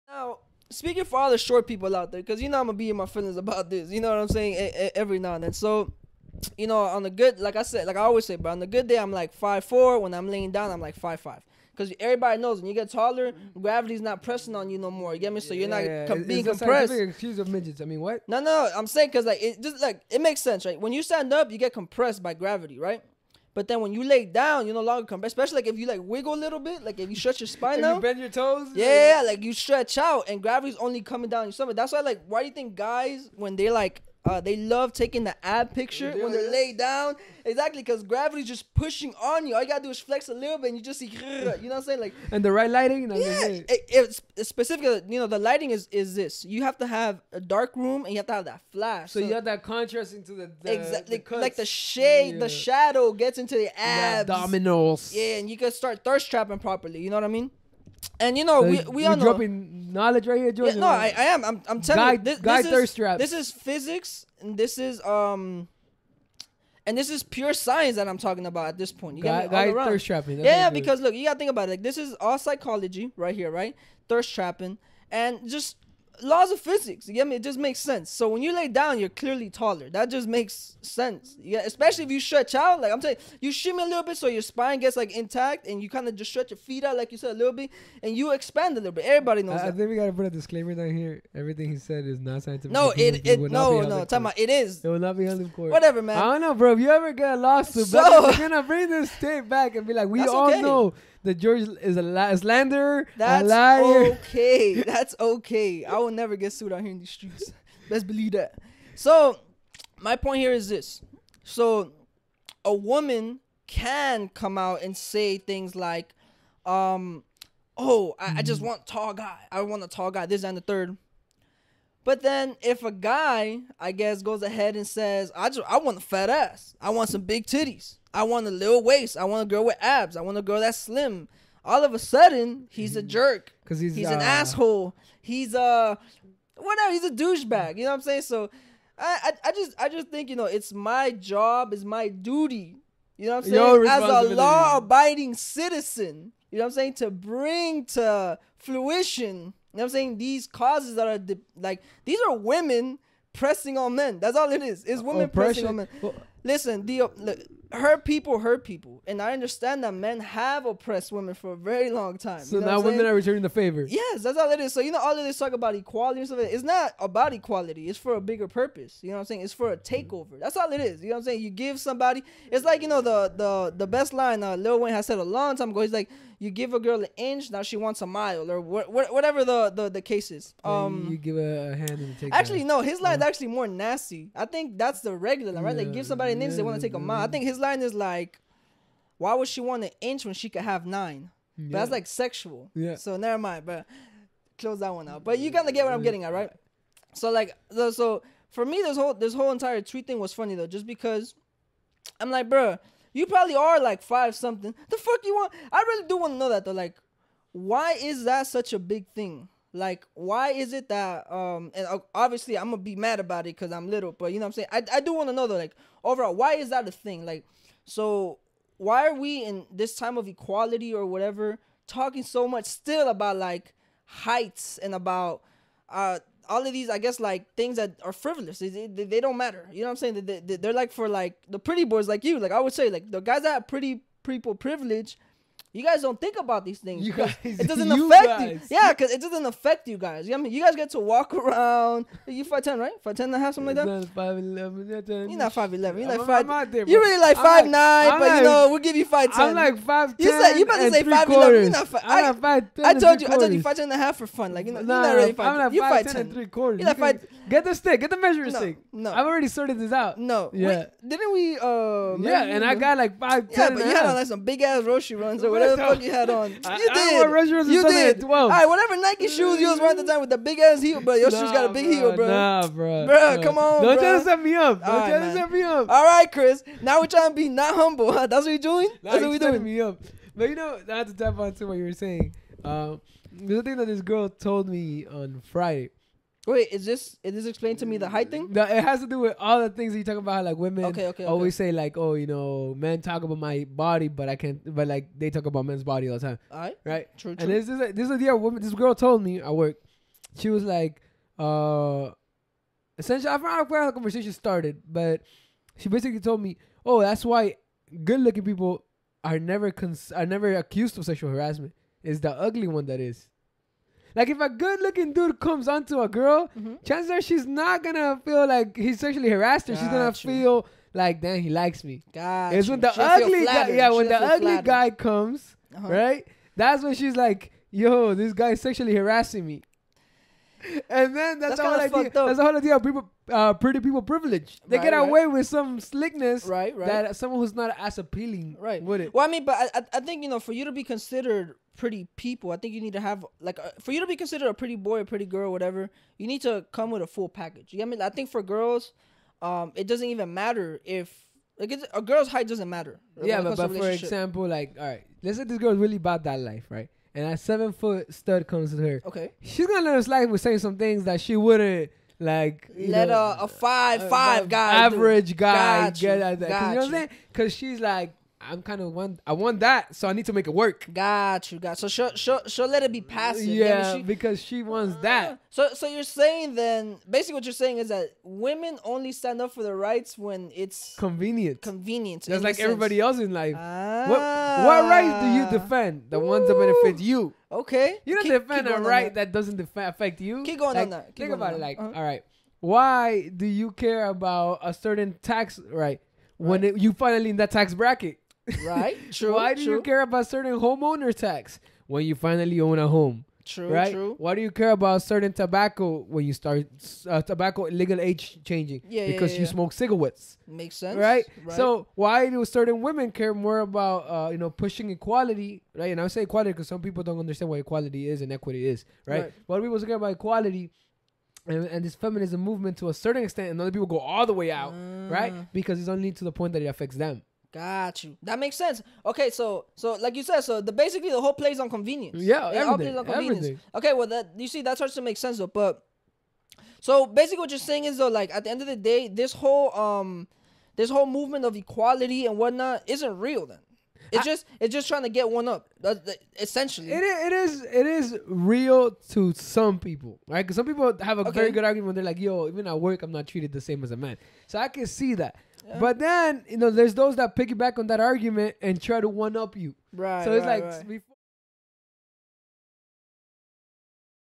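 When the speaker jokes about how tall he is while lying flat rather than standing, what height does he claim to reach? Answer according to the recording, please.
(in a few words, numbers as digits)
5'5".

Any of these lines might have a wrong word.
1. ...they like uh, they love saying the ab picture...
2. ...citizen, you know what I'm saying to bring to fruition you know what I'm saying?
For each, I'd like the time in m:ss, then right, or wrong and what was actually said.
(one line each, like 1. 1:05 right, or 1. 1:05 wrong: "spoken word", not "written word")
1. 0:33 wrong: "taking", not "saying"
2. 2:25 right.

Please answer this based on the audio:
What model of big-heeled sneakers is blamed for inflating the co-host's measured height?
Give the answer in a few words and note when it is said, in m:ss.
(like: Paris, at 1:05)
Nike, at 4:28.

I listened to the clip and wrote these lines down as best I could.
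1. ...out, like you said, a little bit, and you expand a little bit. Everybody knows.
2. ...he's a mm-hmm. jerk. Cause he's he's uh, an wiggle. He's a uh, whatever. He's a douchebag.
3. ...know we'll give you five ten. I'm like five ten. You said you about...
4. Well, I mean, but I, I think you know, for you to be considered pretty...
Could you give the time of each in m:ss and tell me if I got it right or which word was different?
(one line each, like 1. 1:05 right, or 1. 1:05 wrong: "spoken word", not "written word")
1. 1:26 right
2. 2:12 wrong: "asshole", not "wiggle"
3. 4:08 right
4. 5:39 right.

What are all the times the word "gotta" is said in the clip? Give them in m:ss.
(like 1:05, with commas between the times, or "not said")
0:39, 1:11, 1:29.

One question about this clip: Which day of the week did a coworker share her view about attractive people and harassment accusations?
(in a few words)
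Friday.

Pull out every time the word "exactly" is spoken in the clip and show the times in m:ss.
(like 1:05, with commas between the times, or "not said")
0:37, 0:50.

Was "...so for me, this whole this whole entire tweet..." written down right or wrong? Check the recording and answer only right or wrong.
right.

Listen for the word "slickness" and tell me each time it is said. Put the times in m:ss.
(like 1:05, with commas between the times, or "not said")
5:35.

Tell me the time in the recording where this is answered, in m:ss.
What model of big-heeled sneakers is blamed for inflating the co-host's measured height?
4:24.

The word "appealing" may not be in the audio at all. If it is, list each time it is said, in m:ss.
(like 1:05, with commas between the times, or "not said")
5:37.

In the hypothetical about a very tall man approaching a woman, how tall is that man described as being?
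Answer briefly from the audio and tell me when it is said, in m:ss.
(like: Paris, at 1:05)
7 feet, at 5:57.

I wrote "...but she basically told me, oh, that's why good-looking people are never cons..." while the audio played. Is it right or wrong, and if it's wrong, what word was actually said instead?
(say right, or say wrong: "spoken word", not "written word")
right.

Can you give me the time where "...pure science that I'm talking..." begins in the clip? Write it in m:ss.
1:07.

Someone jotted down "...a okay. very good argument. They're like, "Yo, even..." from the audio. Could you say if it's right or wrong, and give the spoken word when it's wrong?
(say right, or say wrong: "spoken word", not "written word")
right.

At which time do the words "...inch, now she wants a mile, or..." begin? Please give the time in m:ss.
2:57.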